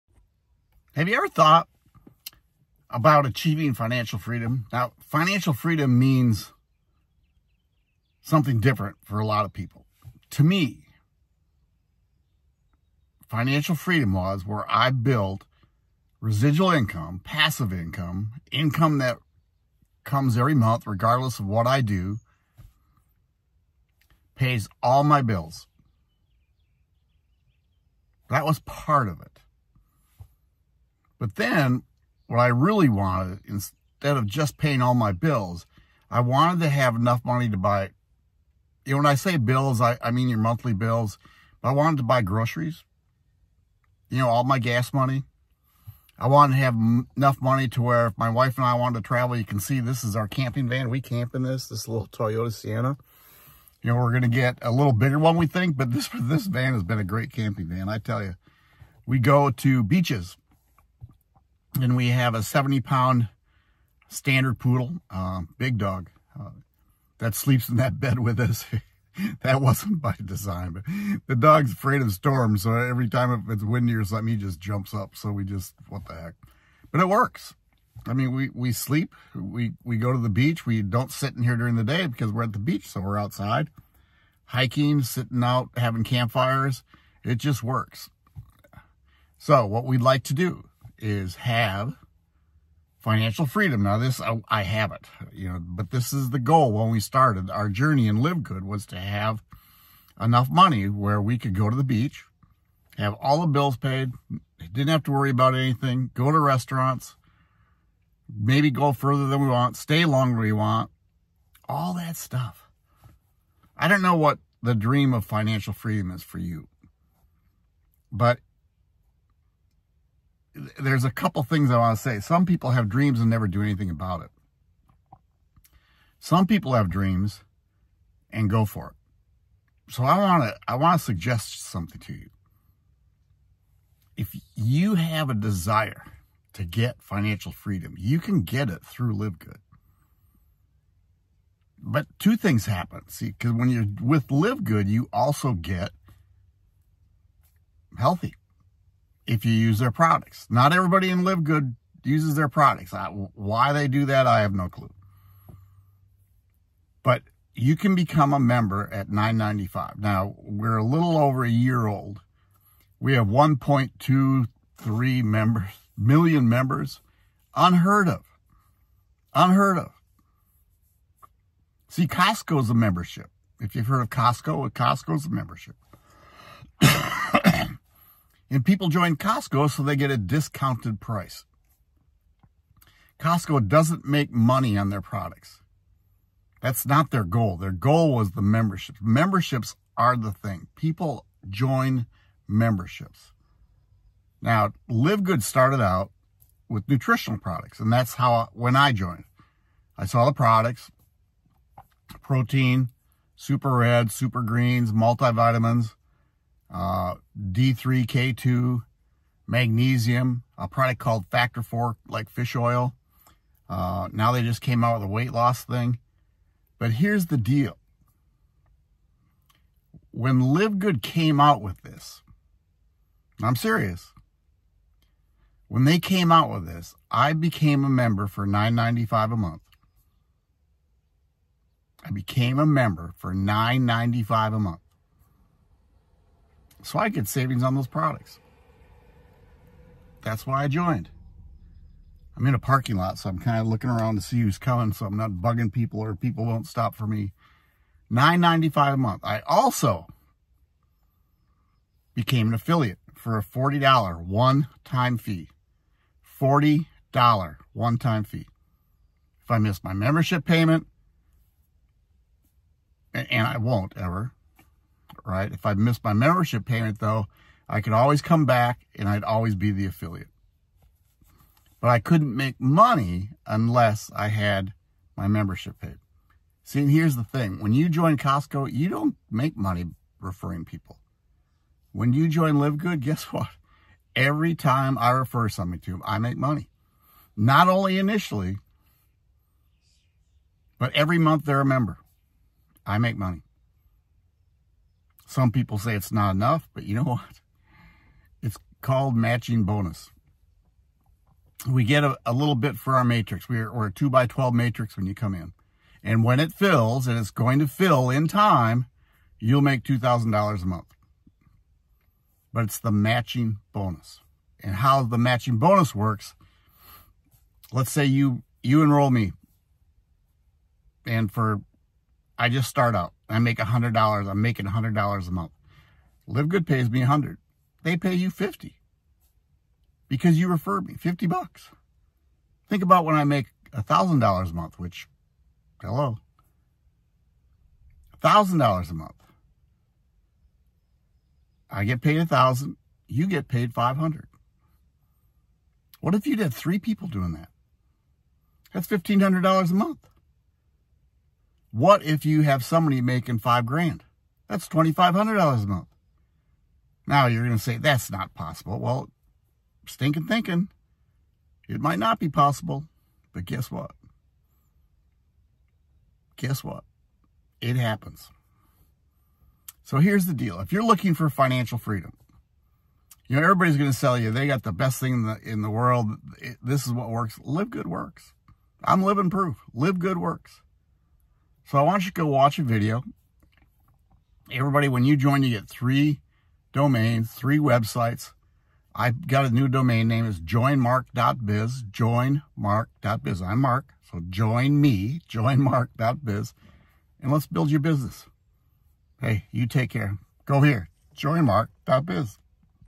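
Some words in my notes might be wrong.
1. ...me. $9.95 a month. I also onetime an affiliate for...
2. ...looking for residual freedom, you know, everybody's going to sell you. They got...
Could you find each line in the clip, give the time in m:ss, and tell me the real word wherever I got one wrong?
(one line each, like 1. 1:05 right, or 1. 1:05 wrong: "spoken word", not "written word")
1. 4:07 wrong: "became", not "onetime"
2. 6:10 wrong: "financial", not "residual".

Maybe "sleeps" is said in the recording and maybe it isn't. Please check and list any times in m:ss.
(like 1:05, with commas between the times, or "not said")
1:07, 1:18.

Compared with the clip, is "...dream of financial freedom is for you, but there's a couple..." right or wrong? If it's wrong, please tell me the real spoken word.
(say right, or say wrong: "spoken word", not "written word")
right.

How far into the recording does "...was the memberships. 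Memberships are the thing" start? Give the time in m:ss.
3:08.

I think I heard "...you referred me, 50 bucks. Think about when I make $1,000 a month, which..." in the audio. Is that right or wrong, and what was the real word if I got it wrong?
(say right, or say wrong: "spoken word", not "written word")
right.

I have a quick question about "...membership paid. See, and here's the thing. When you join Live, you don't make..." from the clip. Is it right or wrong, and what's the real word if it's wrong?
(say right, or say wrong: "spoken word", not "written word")
wrong: "Costco", not "Live".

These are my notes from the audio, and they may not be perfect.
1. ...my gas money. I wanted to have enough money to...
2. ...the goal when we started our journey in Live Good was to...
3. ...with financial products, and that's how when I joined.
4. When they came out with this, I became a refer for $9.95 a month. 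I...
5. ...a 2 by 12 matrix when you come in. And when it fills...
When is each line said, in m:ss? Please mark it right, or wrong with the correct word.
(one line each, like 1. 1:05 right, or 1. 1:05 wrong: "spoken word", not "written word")
1. 0:44 right
2. 1:36 right
3. 3:16 wrong: "nutritional", not "financial"
4. 3:45 wrong: "member", not "refer"
5. 5:03 right.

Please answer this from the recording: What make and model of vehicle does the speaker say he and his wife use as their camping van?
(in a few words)
Toyota Sienna.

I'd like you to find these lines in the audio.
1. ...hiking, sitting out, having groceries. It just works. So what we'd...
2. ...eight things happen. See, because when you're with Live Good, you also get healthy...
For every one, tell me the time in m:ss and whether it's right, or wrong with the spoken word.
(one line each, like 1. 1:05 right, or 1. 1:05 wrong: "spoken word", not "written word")
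1. 1:24 wrong: "campfires", not "groceries"
2. 2:22 wrong: "two", not "eight".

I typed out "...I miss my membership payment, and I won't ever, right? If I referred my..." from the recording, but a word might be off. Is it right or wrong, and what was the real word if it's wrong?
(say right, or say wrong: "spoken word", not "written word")
wrong: "missed", not "referred".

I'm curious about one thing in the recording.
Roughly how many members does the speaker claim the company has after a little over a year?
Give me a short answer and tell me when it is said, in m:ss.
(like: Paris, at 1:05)
1.23 million, at 2:43.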